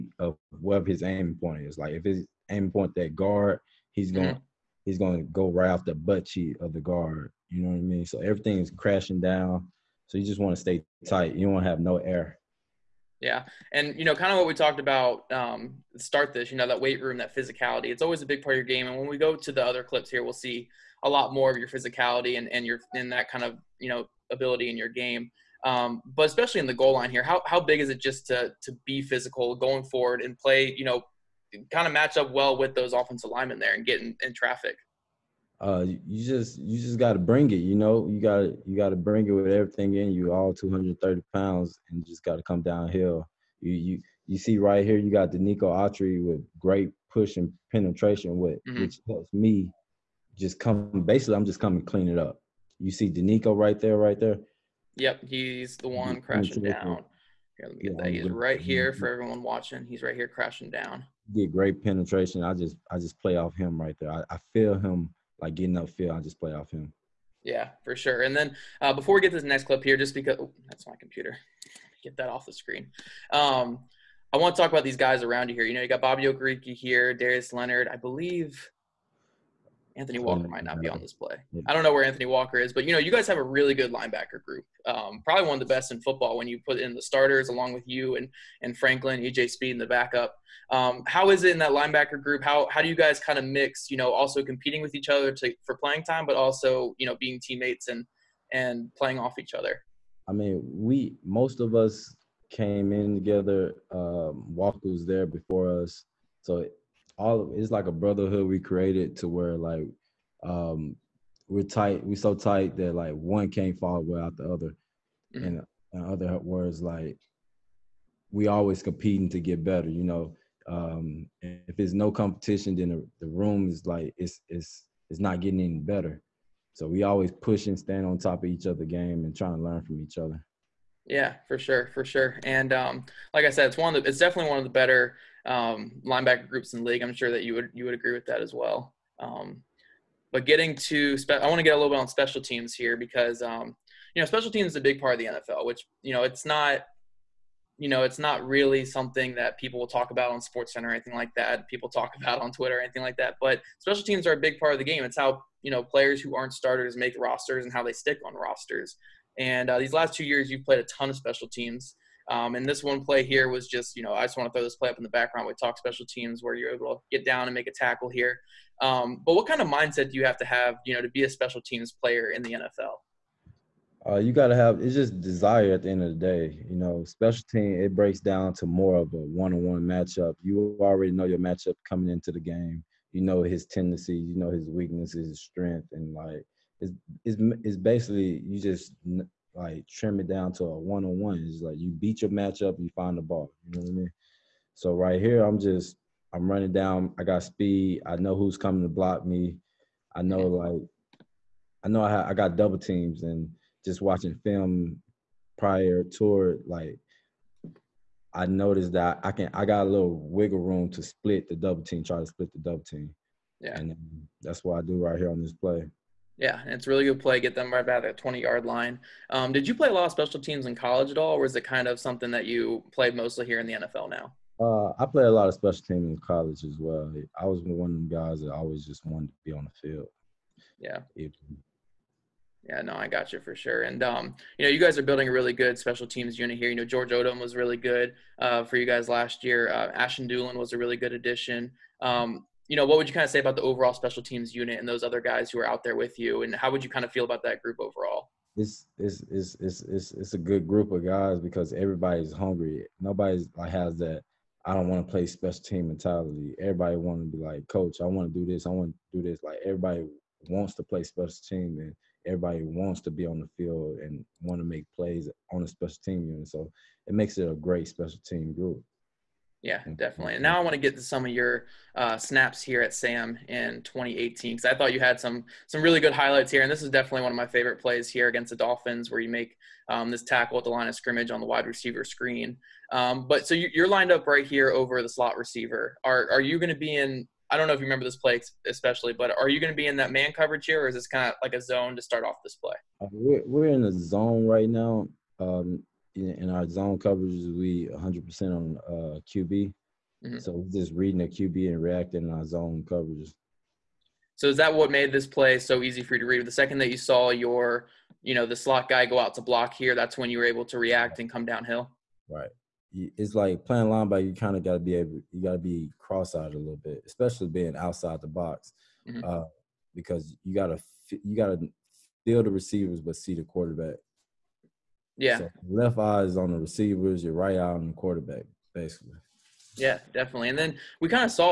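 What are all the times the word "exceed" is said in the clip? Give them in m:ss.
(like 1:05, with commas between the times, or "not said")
not said.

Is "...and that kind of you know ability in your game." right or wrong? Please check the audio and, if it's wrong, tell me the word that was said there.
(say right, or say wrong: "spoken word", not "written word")
right.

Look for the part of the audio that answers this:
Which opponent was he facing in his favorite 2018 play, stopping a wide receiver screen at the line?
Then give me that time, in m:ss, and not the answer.
4:38.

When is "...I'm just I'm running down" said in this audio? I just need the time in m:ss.
3:15.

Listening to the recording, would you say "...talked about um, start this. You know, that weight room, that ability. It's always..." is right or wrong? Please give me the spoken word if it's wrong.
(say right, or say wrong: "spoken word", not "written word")
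wrong: "physicality", not "ability".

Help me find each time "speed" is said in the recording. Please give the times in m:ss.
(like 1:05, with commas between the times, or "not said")
1:29, 3:17.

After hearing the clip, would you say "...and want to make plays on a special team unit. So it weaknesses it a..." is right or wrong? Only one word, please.
wrong.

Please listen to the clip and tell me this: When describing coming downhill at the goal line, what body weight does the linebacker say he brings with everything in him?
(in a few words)
230 pounds.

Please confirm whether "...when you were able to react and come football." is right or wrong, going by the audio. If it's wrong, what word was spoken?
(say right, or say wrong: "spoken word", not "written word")
wrong: "downhill", not "football".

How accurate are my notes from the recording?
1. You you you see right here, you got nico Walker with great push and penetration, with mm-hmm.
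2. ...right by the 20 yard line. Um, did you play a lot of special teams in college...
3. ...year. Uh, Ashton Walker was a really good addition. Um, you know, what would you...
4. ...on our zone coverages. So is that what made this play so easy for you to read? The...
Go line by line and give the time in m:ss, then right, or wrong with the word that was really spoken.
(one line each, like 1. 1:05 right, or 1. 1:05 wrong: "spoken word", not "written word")
1. 0:43 wrong: "Autry", not "Walker"
2. 3:37 right
3. 3:59 wrong: "Dulin", not "Walker"
4. 5:02 right.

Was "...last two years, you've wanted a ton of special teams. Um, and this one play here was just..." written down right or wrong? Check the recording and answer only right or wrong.
wrong.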